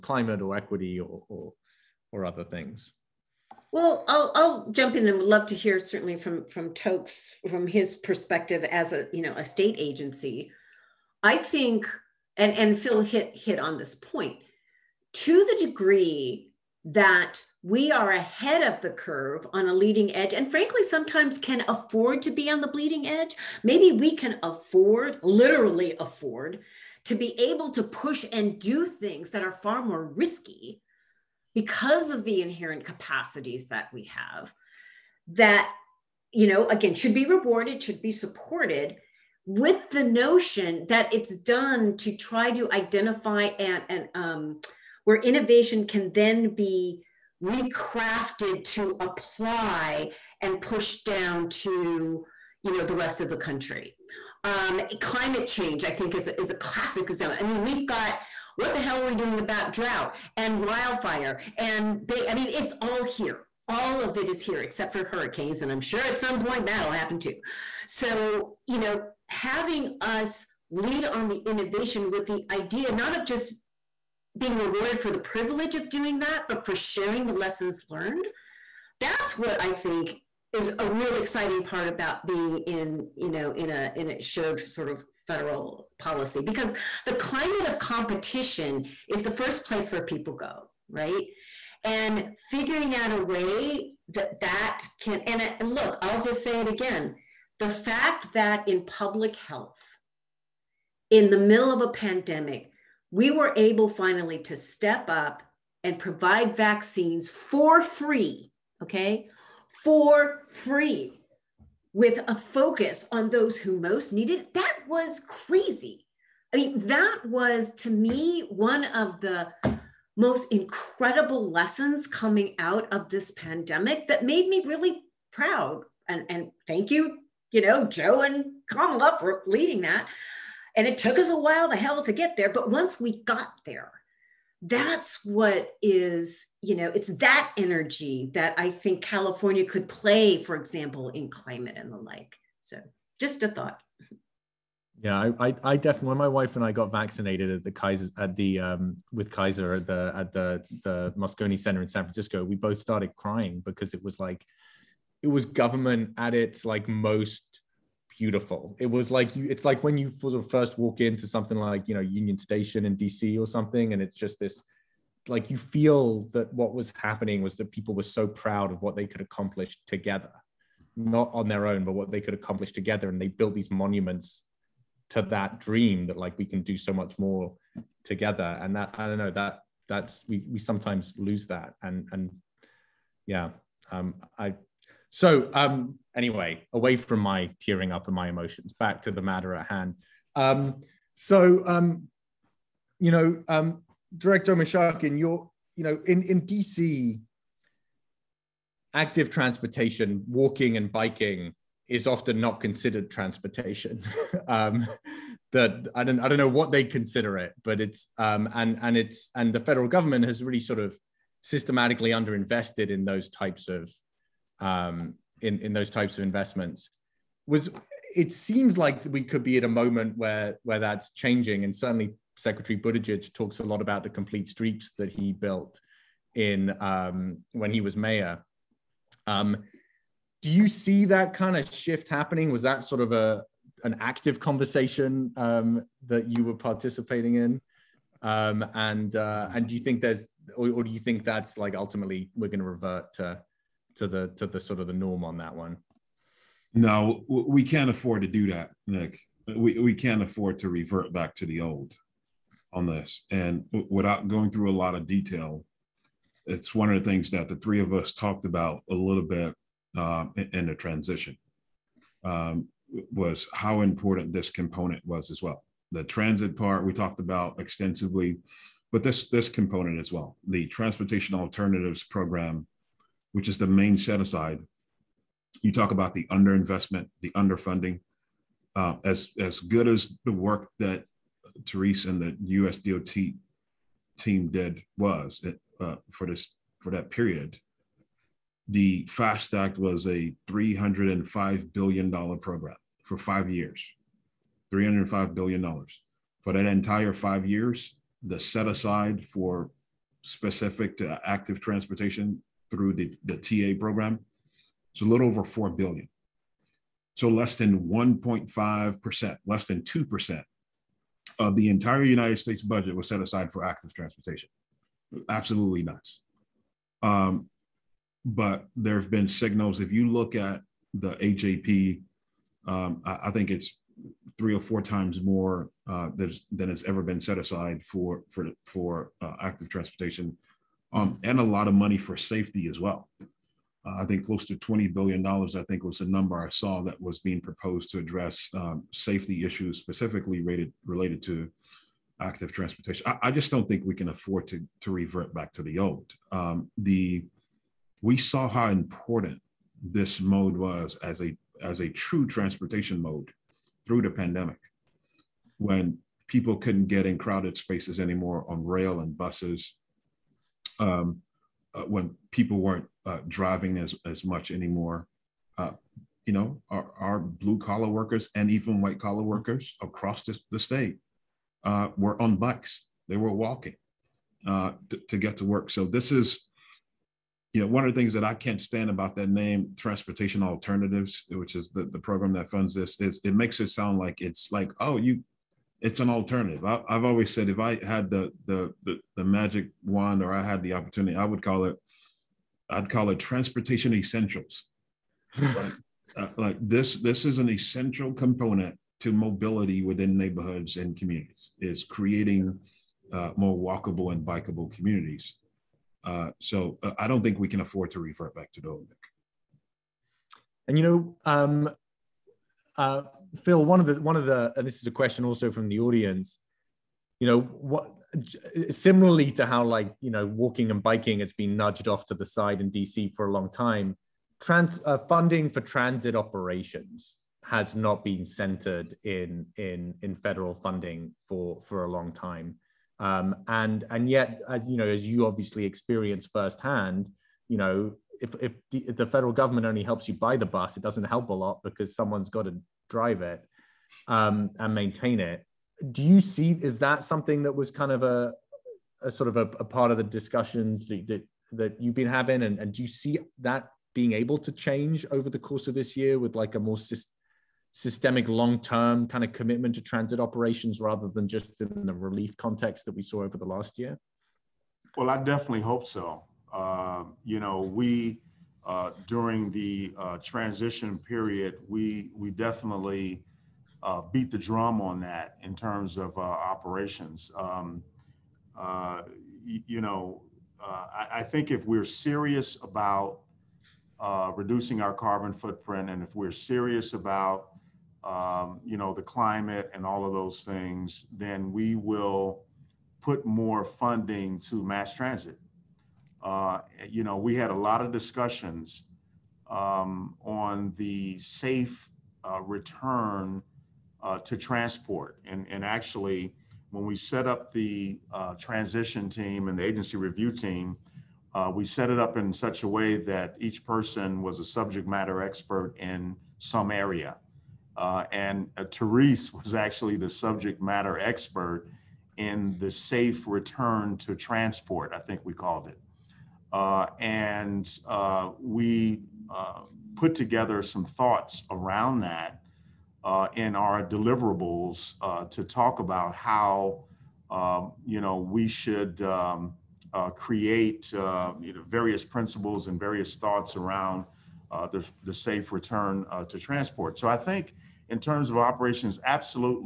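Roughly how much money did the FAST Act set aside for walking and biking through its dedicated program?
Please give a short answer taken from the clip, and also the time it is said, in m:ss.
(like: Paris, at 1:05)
a little over $4 billion, at 5:05.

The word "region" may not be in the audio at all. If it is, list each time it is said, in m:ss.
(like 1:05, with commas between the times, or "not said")
not said.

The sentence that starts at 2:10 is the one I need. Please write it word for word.
And it took us a while the hell to get there.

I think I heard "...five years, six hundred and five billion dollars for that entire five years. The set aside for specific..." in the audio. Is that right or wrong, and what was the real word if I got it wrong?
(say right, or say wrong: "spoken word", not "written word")
wrong: "three", not "six".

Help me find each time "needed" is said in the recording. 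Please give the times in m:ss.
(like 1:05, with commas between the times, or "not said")
1:54.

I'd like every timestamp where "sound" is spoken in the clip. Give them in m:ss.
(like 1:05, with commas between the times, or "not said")
6:23.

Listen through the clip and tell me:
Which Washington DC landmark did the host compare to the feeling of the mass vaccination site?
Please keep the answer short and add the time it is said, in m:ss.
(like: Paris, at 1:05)
Union Station, at 2:41.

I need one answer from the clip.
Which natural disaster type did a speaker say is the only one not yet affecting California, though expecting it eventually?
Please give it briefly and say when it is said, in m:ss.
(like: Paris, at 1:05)
hurricanes, at 1:05.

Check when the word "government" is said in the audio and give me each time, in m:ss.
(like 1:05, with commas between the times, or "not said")
2:35, 3:29, 7:19.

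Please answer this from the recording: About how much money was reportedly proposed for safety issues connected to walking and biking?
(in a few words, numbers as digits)
$20 billion.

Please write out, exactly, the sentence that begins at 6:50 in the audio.
And you know, um, uh, Phil, one of the one of the and this is a question also from the audience.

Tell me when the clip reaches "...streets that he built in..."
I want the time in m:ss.
3:44.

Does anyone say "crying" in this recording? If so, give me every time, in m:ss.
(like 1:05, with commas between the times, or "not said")
2:33.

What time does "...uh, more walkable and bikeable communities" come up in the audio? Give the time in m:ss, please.
6:43.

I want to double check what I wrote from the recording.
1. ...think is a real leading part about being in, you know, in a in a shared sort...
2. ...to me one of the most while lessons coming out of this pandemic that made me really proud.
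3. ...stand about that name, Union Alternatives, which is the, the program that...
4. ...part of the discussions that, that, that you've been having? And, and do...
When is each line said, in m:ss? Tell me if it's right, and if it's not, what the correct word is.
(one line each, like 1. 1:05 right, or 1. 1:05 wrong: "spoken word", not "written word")
1. 1:19 wrong: "exciting", not "leading"
2. 1:57 wrong: "incredible", not "while"
3. 6:18 wrong: "Transportation", not "Union"
4. 7:29 right.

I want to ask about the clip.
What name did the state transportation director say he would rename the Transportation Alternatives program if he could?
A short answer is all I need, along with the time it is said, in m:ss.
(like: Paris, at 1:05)
Transportation Essentials, at 6:33.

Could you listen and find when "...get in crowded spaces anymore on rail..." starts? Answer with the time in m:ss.
5:56.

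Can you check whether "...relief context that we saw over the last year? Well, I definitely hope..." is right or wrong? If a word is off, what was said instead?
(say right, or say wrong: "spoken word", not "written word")
right.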